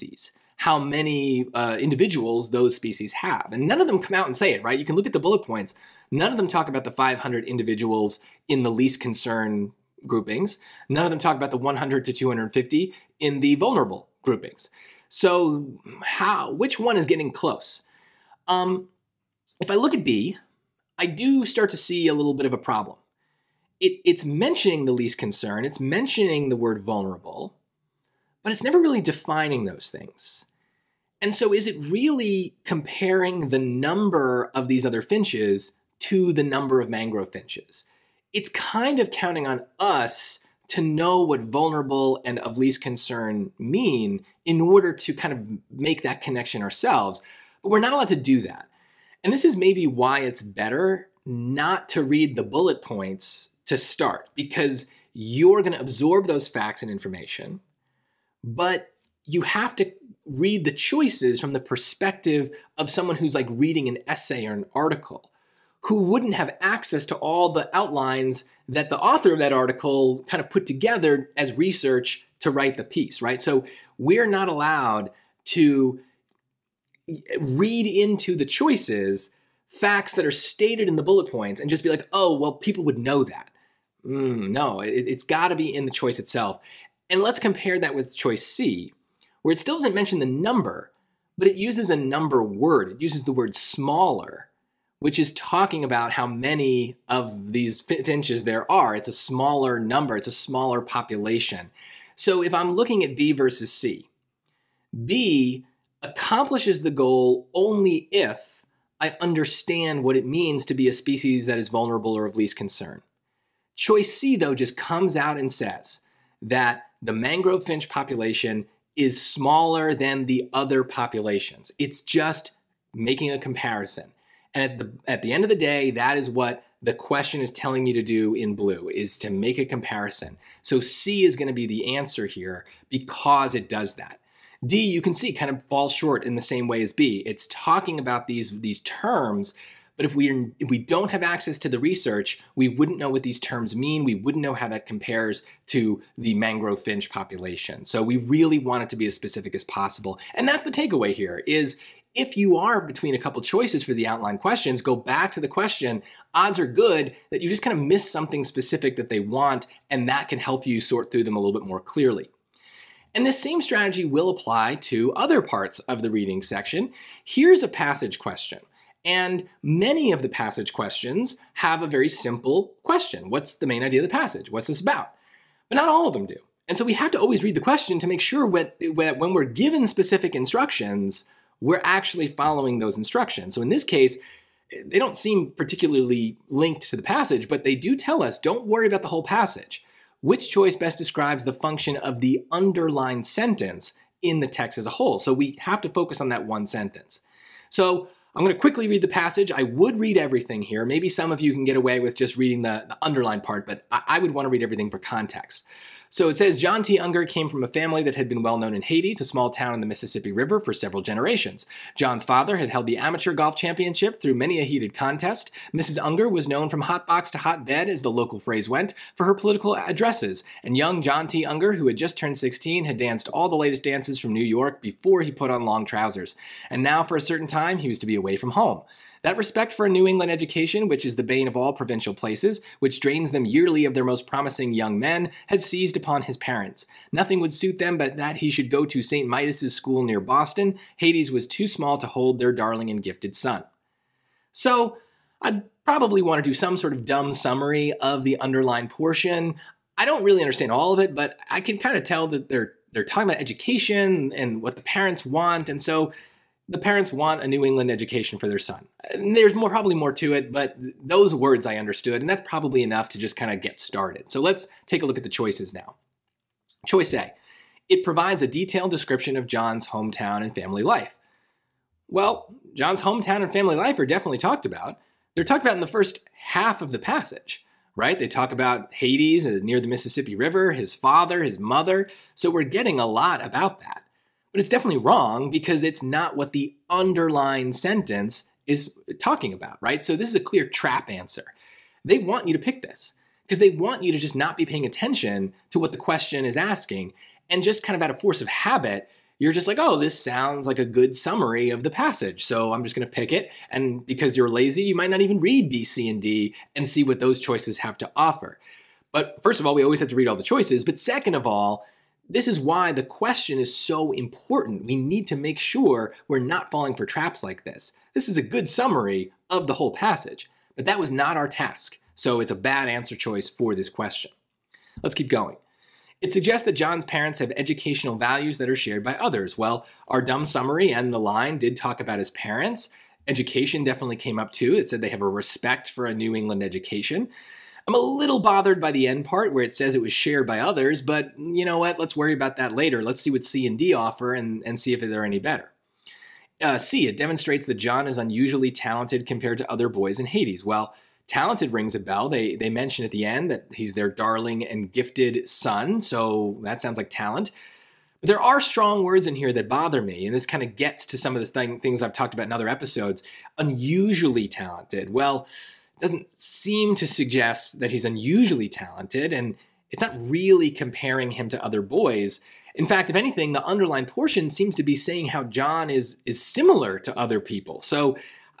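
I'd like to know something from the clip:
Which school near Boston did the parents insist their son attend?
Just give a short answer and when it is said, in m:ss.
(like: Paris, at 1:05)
St. Midas's school, at 3:59.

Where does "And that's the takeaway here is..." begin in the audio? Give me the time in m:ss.
2:30.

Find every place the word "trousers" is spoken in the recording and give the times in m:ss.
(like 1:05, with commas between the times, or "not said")
3:45.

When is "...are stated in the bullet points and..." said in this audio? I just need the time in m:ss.
1:20.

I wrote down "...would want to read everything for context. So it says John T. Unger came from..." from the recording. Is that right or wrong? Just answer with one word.
right.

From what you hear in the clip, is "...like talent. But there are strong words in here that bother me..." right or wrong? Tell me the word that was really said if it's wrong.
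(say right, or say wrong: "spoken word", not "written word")
right.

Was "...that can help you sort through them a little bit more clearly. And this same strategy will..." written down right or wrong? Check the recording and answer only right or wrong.
right.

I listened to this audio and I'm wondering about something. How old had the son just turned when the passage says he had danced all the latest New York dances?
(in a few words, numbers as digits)
16.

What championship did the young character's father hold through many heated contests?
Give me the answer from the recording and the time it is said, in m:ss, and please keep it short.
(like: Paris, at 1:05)
amateur golf championship, at 3:32.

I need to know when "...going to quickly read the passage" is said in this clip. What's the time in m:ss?
3:18.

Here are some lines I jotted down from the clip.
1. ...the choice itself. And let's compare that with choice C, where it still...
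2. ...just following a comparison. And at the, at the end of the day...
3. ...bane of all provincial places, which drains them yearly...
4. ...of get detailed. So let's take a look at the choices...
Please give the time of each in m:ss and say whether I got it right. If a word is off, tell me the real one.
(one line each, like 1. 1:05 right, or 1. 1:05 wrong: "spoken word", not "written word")
1. 1:25 right
2. 2:02 wrong: "making", not "following"
3. 3:51 right
4. 4:23 wrong: "started", not "detailed".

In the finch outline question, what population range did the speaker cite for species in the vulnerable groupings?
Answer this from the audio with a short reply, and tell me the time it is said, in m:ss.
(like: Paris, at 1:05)
100 to 250, at 0:11.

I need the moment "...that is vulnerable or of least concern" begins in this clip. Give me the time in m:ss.
1:51.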